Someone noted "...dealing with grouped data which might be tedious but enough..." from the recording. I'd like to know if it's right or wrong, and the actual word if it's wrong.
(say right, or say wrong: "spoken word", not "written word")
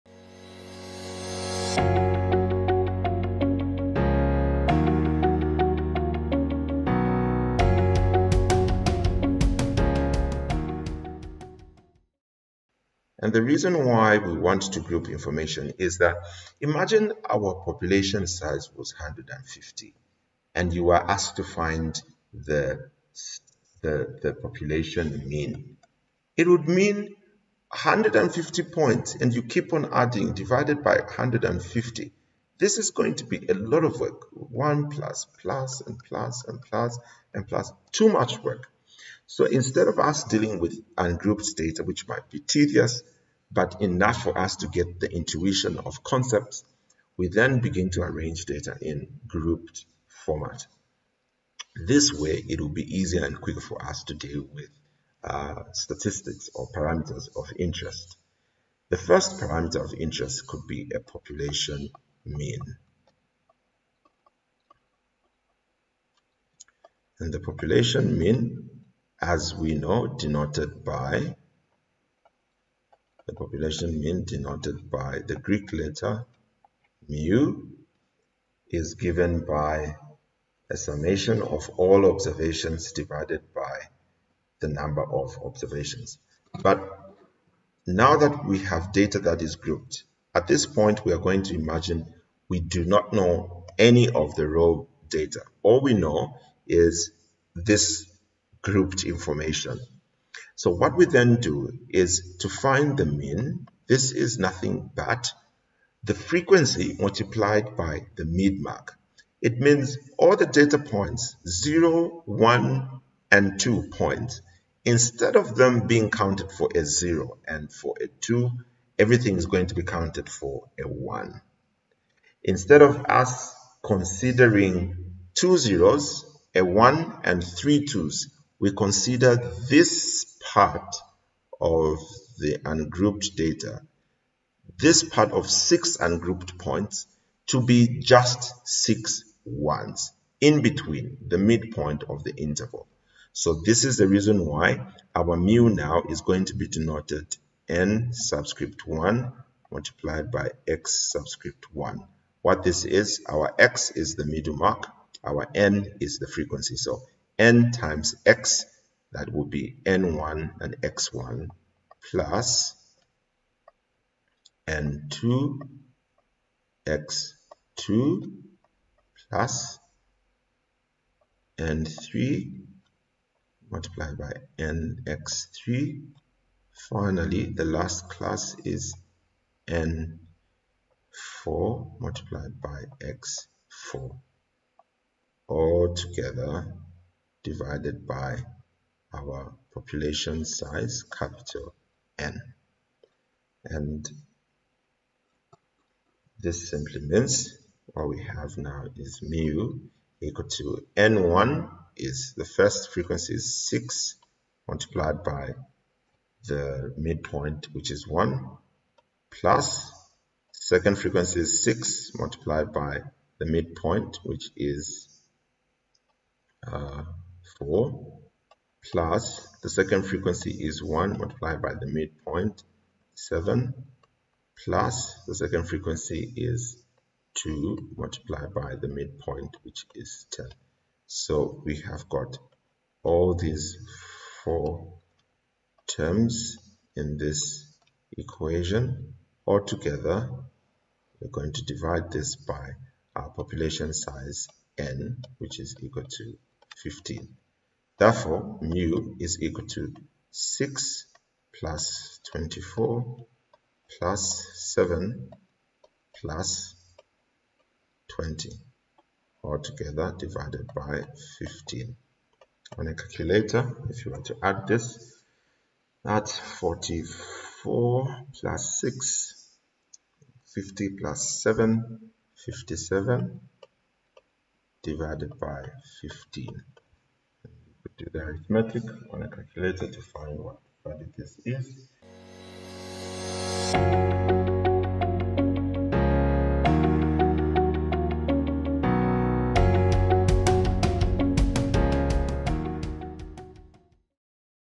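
wrong: "ungrouped", not "grouped".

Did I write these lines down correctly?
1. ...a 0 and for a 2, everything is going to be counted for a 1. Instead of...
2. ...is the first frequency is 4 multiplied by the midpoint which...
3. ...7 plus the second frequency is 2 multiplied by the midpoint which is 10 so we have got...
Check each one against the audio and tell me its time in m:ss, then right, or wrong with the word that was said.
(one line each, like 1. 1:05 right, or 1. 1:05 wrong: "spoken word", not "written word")
1. 1:56 right
2. 3:22 wrong: "6", not "4"
3. 3:43 right.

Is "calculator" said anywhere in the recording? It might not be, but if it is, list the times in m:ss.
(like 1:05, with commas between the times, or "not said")
4:22, 4:39.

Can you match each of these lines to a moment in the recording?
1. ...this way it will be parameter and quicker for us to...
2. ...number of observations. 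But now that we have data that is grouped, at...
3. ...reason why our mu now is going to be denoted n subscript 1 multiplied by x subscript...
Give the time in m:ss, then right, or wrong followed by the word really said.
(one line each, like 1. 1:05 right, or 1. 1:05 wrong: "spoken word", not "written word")
1. 0:51 wrong: "easier", not "parameter"
2. 1:24 right
3. 2:24 right.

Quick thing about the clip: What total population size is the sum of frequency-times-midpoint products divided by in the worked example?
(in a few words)
15.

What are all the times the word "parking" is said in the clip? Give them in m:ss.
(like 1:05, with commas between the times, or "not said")
not said.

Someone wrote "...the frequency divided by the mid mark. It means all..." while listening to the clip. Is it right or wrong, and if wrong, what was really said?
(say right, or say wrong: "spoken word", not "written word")
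wrong: "multiplied", not "divided".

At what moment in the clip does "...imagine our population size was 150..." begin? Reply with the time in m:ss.
0:16.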